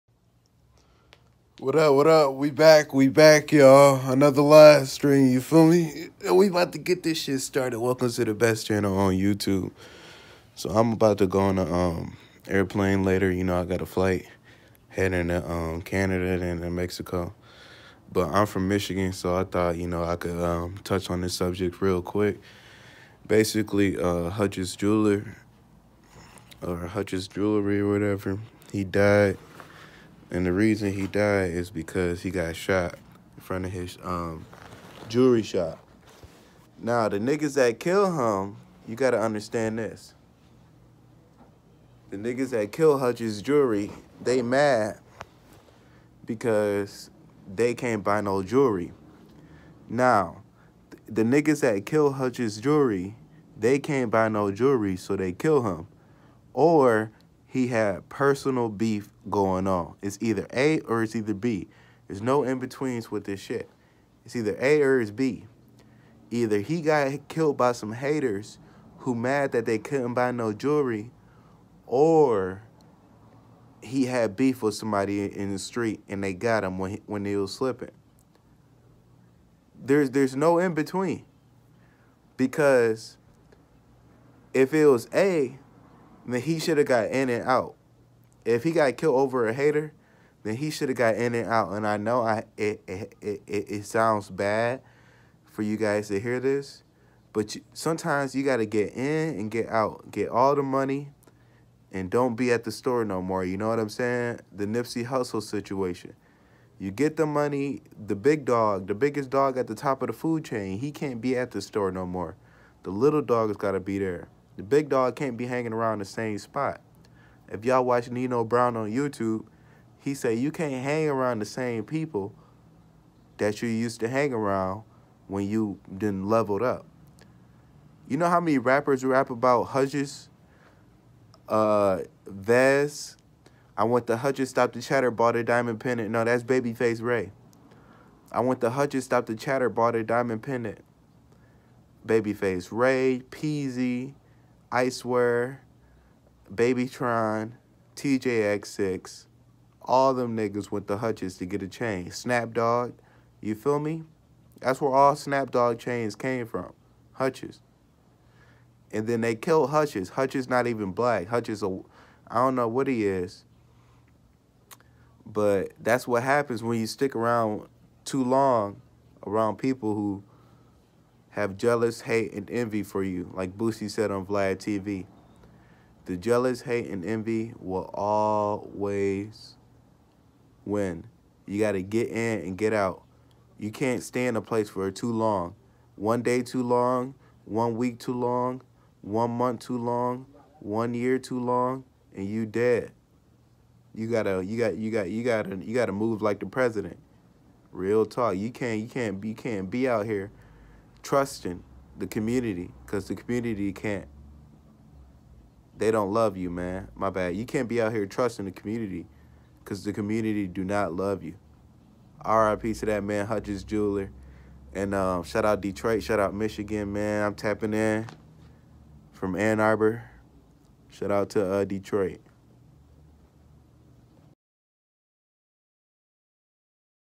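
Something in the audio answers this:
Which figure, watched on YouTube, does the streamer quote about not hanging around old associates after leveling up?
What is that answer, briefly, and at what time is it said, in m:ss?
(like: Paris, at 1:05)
Nino Brown, at 1:58.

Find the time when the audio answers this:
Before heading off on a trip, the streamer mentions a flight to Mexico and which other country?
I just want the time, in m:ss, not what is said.
0:15.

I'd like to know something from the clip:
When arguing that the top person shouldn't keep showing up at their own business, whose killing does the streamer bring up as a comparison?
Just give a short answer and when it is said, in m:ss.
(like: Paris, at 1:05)
Nipsey Hussle, at 1:44.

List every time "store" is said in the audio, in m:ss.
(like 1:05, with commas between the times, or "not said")
1:42, 1:51.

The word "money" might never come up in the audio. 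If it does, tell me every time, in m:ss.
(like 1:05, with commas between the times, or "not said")
1:40, 1:47.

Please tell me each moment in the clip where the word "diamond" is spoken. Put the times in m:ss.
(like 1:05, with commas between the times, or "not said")
2:15, 2:20.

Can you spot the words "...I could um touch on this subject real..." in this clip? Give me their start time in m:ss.
0:20.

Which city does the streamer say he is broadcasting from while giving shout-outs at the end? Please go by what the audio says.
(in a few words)
Ann Arbor.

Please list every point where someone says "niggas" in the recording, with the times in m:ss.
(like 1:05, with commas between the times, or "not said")
0:37, 0:42, 0:51, 2:30.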